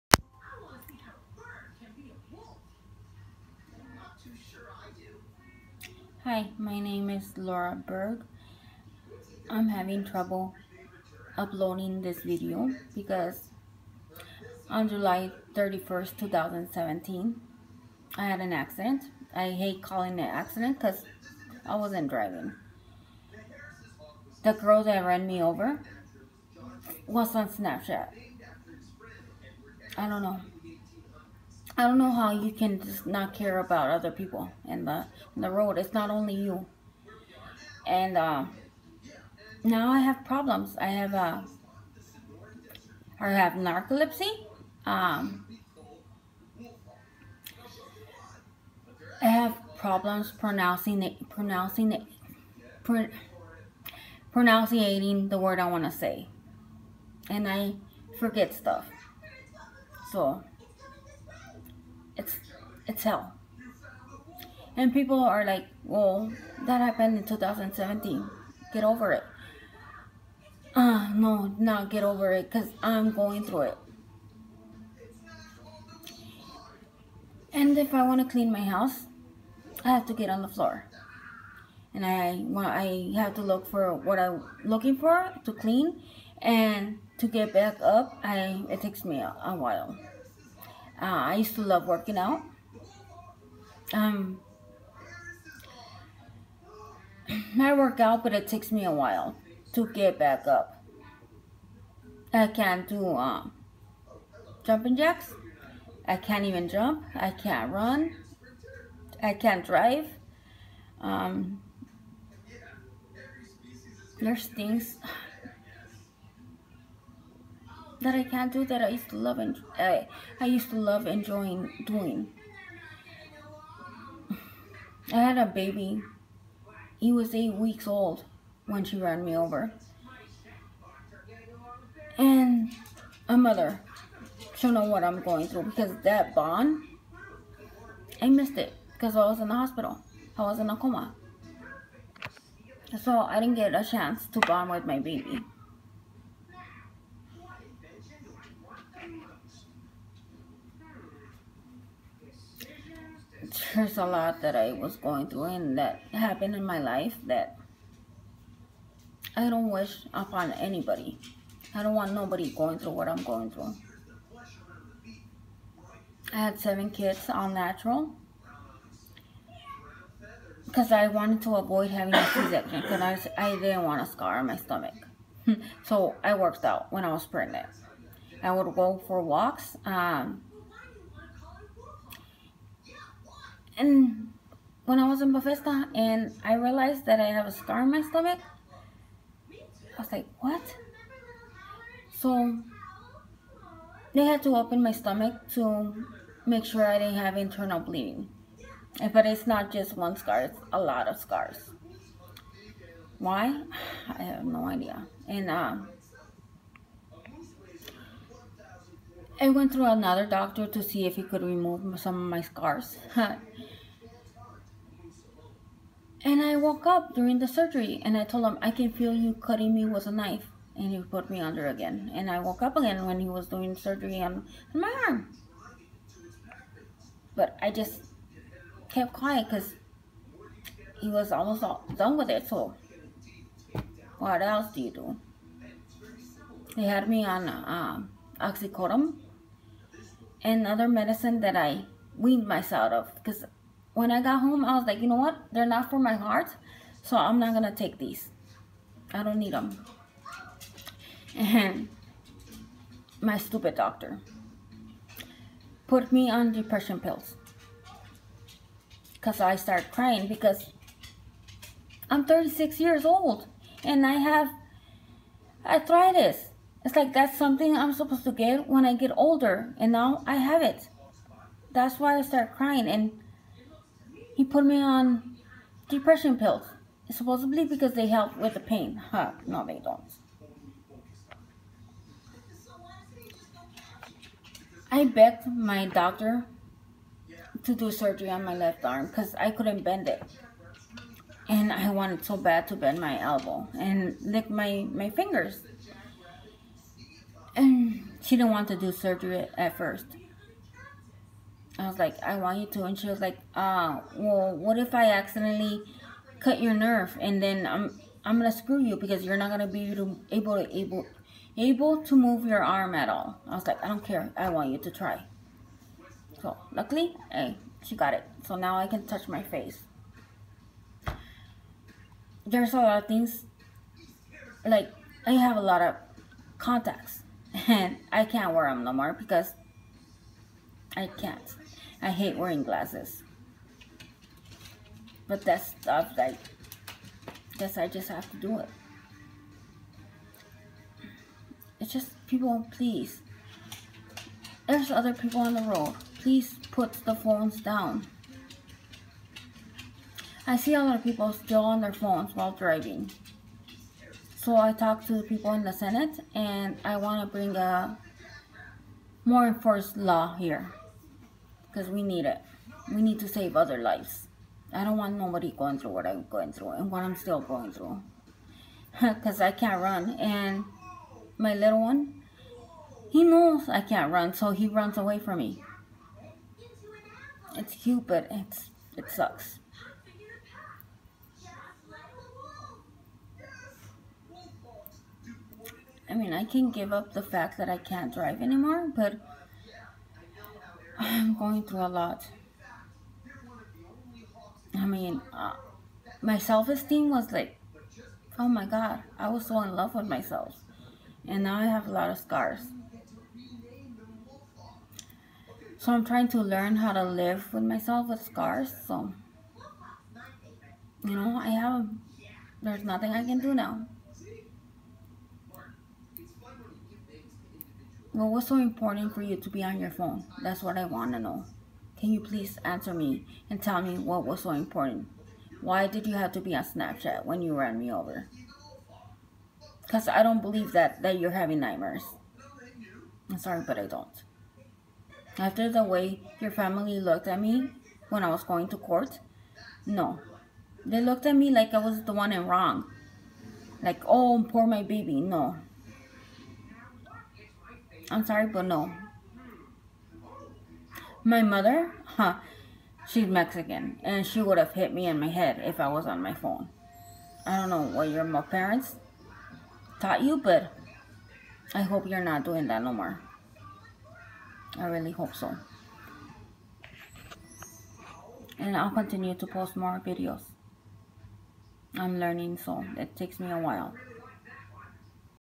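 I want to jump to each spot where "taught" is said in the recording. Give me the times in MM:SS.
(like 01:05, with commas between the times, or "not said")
07:40.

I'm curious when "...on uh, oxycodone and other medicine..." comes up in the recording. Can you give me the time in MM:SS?
03:57.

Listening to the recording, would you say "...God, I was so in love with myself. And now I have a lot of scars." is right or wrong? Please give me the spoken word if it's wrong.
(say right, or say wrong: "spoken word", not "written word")
right.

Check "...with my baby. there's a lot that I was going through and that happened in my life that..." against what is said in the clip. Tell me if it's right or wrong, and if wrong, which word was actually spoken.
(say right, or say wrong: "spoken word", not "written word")
right.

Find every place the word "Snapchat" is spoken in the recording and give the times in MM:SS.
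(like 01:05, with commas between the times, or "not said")
00:27, 07:06.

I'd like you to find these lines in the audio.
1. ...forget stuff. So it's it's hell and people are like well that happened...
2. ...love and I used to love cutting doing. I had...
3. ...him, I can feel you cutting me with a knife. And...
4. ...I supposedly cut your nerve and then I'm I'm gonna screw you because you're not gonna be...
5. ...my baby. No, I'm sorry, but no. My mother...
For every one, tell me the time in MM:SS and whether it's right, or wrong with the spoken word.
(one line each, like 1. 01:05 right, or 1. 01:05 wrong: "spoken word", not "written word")
1. 00:58 right
2. 01:59 wrong: "enjoying", not "cutting"
3. 03:38 right
4. 05:04 wrong: "accidentally", not "supposedly"
5. 07:24 right.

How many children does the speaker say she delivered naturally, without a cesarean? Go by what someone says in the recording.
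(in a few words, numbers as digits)
7.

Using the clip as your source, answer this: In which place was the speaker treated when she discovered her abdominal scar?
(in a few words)
Bethesda.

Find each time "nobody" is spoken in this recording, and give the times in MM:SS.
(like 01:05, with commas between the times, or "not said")
02:42, 06:05.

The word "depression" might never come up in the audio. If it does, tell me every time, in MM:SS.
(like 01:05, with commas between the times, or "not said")
04:16, 04:35.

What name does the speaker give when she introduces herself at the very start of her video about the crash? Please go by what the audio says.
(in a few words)
Laura Berg.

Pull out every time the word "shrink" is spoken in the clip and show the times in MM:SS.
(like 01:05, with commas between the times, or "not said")
not said.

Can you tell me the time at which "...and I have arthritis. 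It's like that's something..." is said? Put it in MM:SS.
04:23.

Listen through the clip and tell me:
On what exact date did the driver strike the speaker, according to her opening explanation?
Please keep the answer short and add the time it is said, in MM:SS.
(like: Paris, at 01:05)
July 31st, 2017, at 00:14.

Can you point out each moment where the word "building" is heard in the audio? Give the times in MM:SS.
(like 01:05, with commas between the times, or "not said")
not said.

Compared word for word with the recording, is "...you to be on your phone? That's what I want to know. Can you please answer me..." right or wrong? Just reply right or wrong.
right.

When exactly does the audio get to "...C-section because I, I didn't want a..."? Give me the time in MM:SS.
02:52.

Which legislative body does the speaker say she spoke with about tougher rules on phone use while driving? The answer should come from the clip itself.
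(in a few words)
The Senate.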